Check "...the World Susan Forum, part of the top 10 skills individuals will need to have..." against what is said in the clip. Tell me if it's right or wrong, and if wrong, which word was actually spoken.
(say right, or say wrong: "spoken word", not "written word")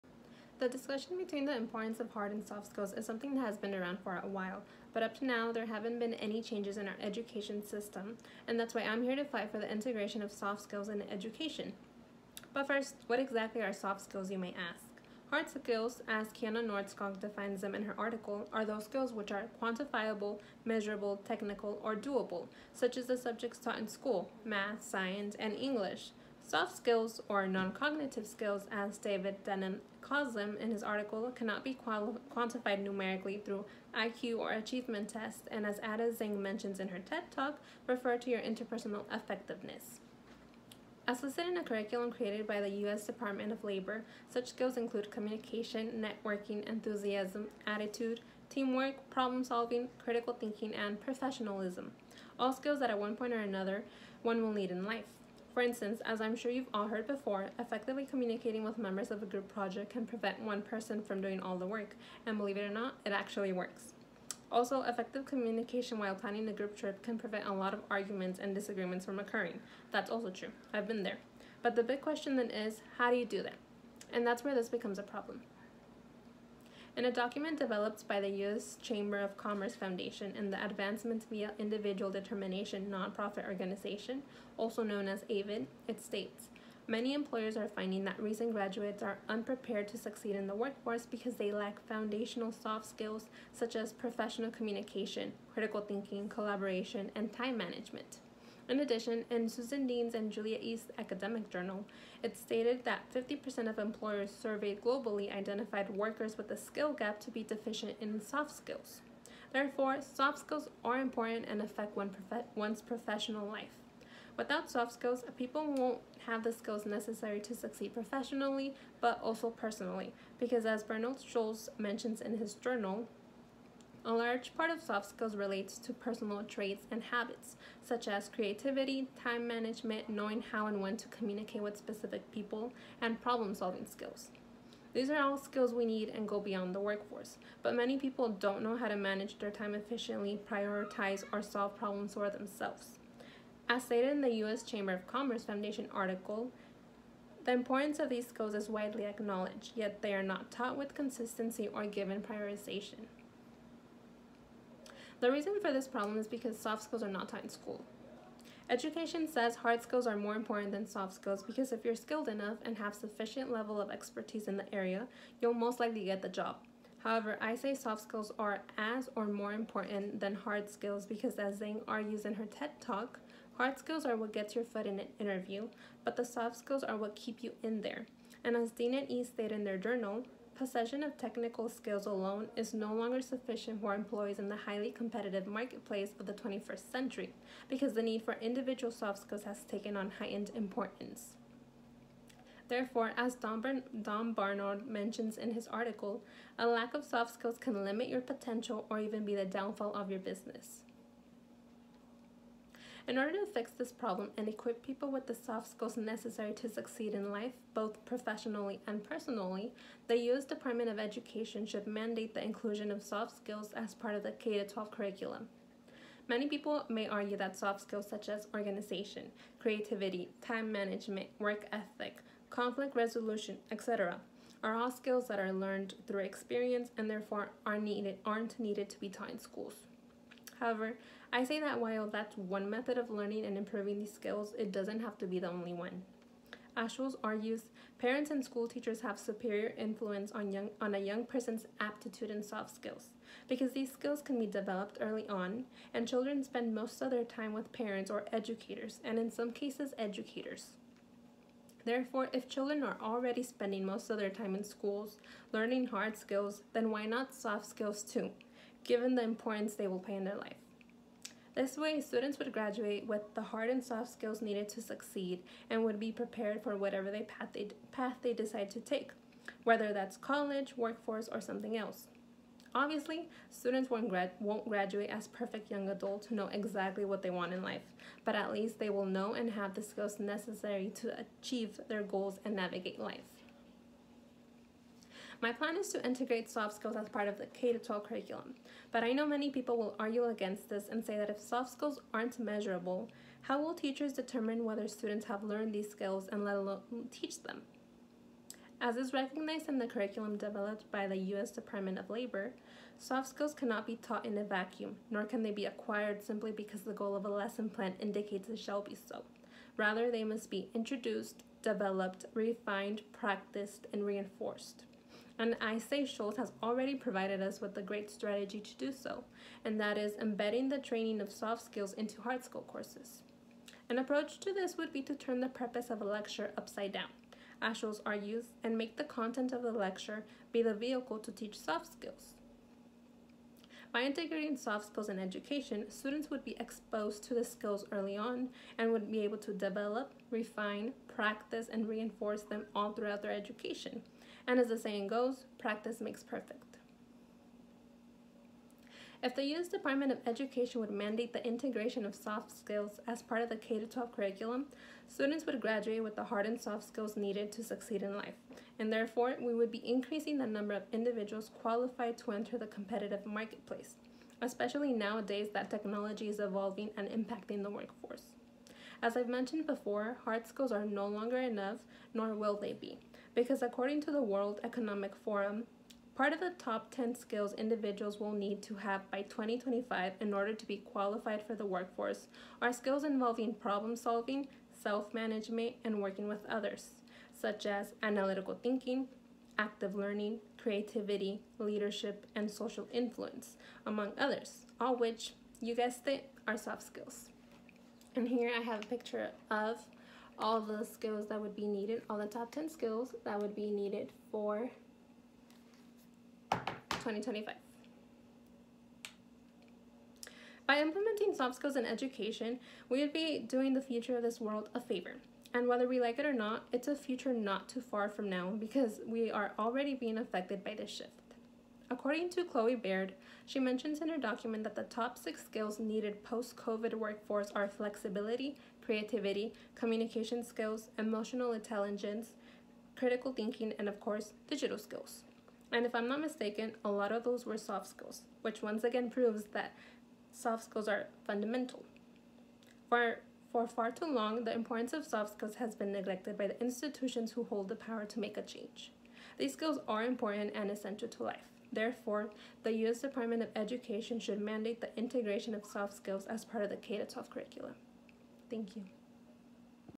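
wrong: "Economic", not "Susan".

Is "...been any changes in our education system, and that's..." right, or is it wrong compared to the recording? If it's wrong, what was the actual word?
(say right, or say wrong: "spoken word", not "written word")
right.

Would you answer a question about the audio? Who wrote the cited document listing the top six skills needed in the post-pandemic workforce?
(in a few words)
Chloe Baird.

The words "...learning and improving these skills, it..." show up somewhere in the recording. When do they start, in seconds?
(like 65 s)
233 s.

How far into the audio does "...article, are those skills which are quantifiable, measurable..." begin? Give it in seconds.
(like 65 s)
17 s.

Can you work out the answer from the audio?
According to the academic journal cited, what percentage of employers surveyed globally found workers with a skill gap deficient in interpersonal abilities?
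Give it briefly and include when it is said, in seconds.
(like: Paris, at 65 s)
50%, at 103 s.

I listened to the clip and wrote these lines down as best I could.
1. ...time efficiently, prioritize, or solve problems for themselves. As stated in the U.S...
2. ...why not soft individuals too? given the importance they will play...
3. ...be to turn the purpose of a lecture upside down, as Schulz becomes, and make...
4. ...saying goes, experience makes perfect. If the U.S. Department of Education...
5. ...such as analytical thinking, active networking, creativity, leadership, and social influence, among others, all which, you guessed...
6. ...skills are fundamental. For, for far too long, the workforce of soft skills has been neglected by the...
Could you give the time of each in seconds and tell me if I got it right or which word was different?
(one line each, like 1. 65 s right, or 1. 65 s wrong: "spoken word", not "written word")
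1. 139 s right
2. 256 s wrong: "skills", not "individuals"
3. 324 s wrong: "argues", not "becomes"
4. 344 s wrong: "practice", not "experience"
5. 387 s wrong: "learning", not "networking"
6. 440 s wrong: "importance", not "workforce".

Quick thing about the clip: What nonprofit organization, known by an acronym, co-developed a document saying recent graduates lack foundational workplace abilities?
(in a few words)
AVID.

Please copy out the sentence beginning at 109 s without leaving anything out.
Therefore, soft skills are important and affect one prof one's professional life.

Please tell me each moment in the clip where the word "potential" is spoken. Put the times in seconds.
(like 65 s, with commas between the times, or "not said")
198 s.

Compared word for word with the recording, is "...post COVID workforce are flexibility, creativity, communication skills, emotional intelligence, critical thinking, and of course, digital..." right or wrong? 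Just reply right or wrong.
right.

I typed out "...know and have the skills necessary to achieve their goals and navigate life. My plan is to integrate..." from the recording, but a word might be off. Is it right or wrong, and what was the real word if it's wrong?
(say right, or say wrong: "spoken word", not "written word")
right.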